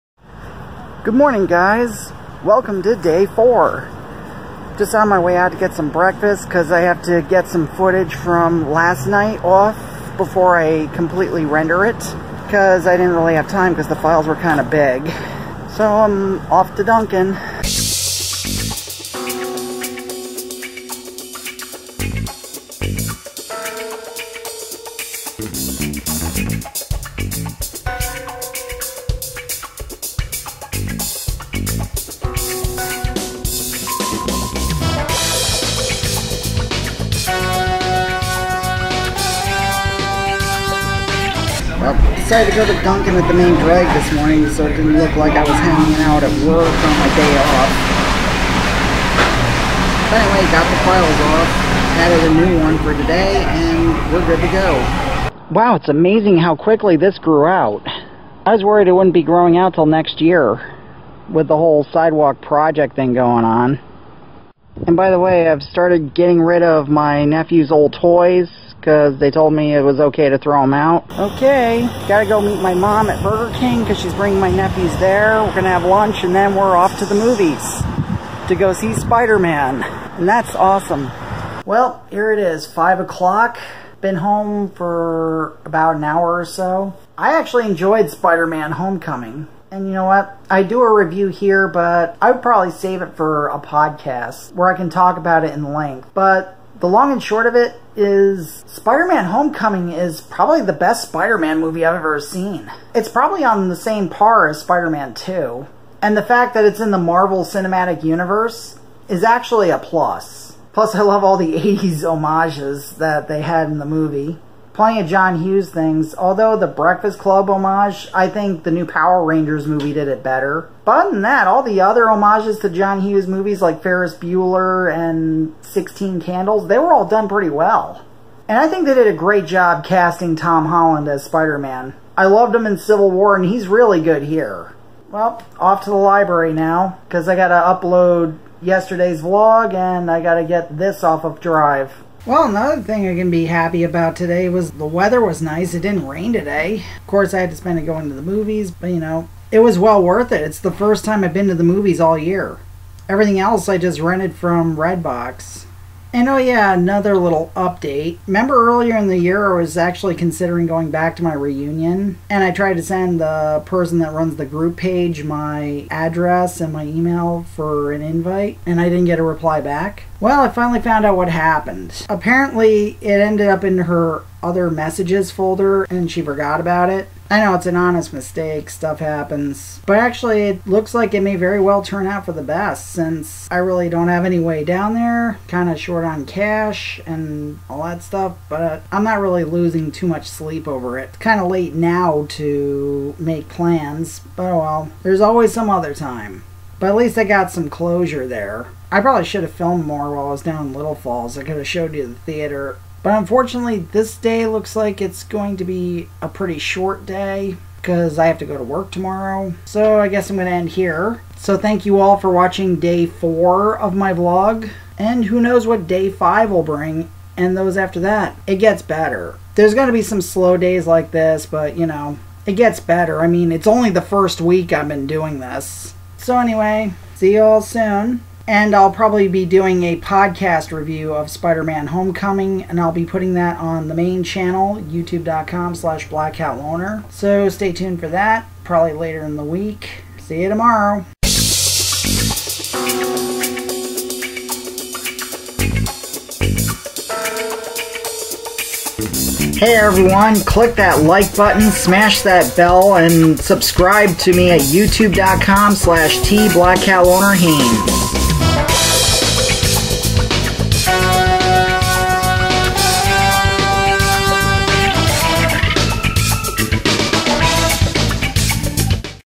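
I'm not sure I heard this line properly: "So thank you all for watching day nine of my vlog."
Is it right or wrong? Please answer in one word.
wrong.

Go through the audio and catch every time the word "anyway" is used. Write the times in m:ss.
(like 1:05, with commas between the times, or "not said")
0:50, 3:46.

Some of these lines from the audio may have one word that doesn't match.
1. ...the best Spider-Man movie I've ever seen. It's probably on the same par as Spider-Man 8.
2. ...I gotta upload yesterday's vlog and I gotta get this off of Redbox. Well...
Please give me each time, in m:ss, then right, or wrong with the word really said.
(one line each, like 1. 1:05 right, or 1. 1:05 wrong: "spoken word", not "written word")
1. 1:40 wrong: "2", not "8"
2. 2:17 wrong: "Drive", not "Redbox".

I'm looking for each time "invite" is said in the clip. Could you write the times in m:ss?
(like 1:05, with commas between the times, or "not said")
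2:48.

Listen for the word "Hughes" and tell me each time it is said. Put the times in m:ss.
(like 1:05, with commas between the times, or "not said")
1:55, 2:03.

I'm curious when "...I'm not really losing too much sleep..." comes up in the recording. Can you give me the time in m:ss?
3:08.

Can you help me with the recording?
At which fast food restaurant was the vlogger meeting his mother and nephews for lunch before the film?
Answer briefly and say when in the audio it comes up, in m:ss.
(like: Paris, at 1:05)
Burger King, at 1:13.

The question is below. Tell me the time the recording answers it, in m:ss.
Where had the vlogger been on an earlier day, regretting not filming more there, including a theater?
3:20.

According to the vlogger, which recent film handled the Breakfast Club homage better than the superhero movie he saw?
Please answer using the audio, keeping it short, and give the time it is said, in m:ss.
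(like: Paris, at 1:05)
Power Rangers, at 1:58.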